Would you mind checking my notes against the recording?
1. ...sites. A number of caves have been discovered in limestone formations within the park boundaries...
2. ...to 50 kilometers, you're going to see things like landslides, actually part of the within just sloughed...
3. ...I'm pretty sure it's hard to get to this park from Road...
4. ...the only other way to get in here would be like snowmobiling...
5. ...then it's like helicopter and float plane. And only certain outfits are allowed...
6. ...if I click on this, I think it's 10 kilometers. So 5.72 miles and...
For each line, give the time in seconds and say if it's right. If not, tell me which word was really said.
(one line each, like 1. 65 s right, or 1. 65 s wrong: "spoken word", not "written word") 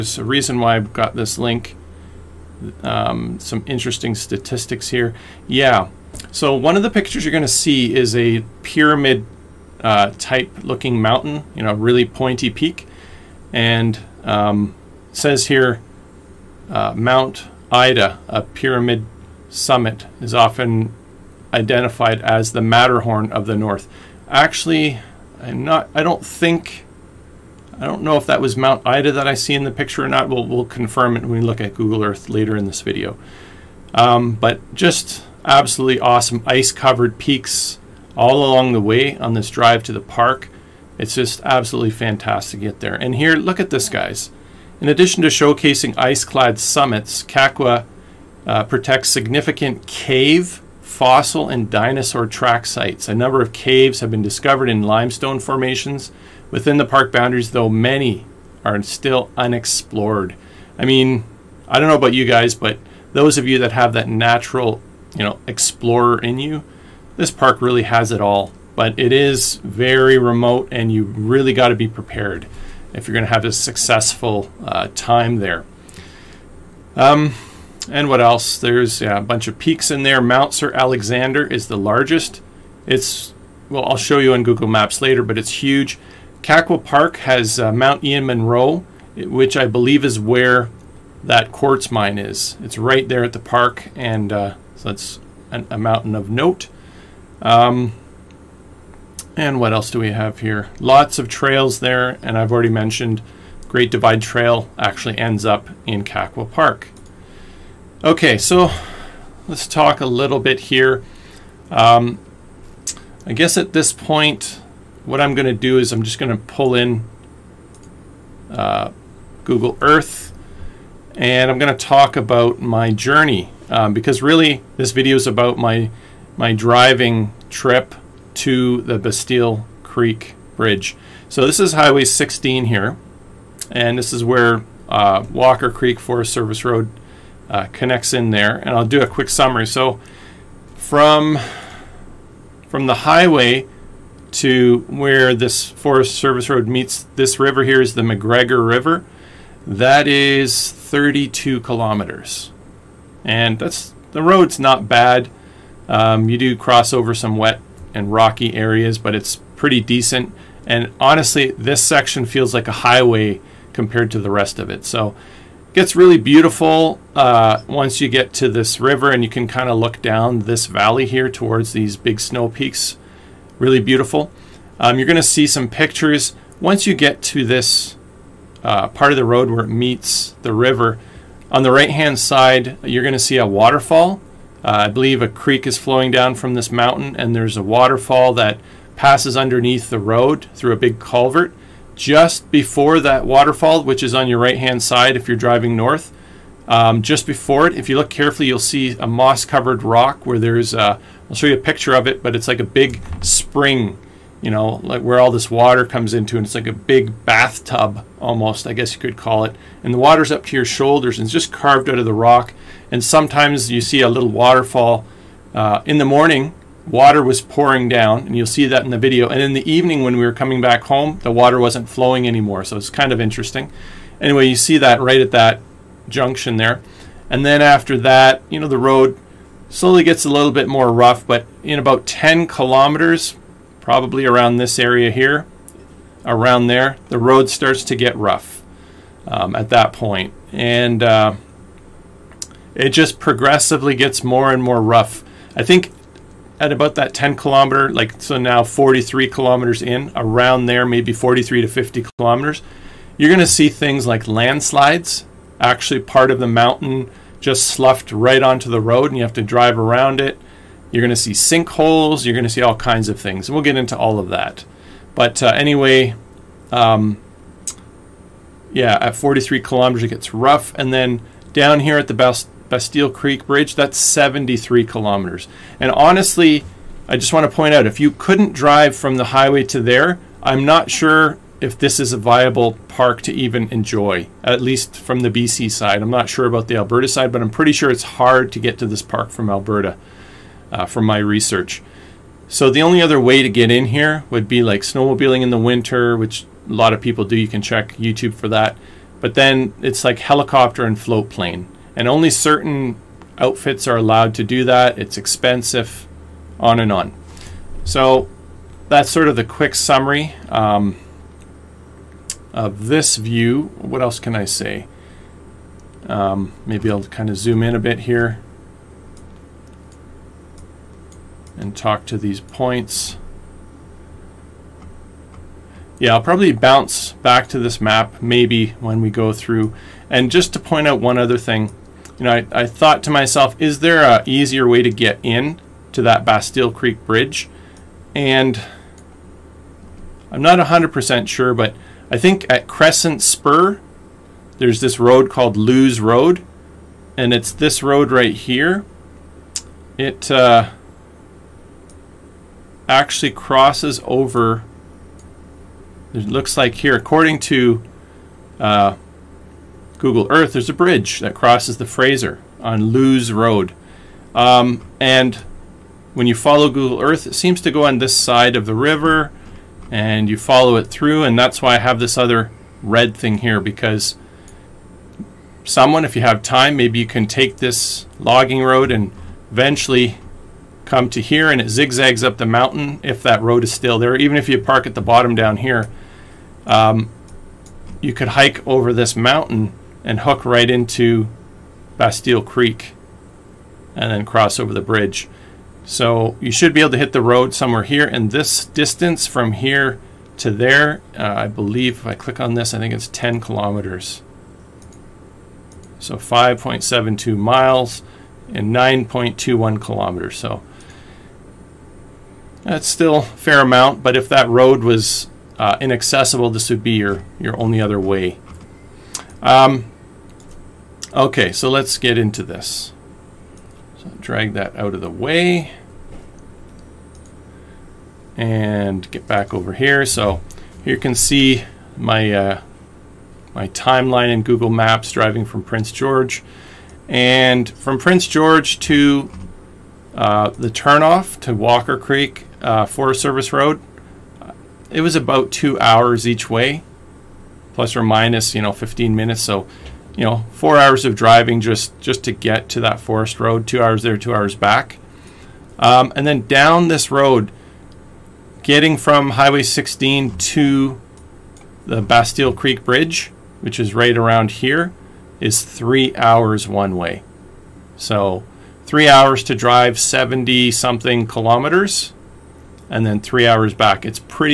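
1. 52 s right
2. 251 s wrong: "mountain", not "within"
3. 287 s wrong: "Alberta", not "Road"
4. 292 s right
5. 299 s right
6. 401 s right.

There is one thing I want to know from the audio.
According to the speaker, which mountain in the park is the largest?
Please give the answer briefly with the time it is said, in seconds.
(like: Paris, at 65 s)
Mount Sir Alexander, at 80 s.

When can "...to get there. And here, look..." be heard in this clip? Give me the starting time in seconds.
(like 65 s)
42 s.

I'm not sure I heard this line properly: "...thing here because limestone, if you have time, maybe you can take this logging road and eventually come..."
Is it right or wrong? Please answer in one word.
wrong.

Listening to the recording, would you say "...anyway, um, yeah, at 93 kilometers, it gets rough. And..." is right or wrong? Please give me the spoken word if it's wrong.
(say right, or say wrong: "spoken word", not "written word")
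wrong: "43", not "93".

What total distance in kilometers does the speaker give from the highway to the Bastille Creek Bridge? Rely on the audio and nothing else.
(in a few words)
73.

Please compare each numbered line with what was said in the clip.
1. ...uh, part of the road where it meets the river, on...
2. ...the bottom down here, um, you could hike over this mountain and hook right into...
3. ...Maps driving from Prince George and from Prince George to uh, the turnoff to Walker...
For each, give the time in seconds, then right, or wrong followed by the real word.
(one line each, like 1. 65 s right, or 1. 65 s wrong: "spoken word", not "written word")
1. 178 s right
2. 384 s right
3. 434 s right.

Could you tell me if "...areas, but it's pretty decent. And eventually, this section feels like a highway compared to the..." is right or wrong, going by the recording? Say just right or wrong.
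wrong.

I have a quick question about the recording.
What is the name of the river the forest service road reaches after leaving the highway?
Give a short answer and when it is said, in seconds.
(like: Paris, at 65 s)
McGregor River, at 148 s.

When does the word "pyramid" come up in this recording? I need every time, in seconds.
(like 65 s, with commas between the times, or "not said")
8 s, 18 s.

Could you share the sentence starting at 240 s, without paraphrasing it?
And uh, it just progressively gets more and more rough.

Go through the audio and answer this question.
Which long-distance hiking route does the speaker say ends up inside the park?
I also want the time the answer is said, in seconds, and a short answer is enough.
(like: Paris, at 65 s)
Great Divide Trail, at 103 s.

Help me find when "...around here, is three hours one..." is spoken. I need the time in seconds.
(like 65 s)
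464 s.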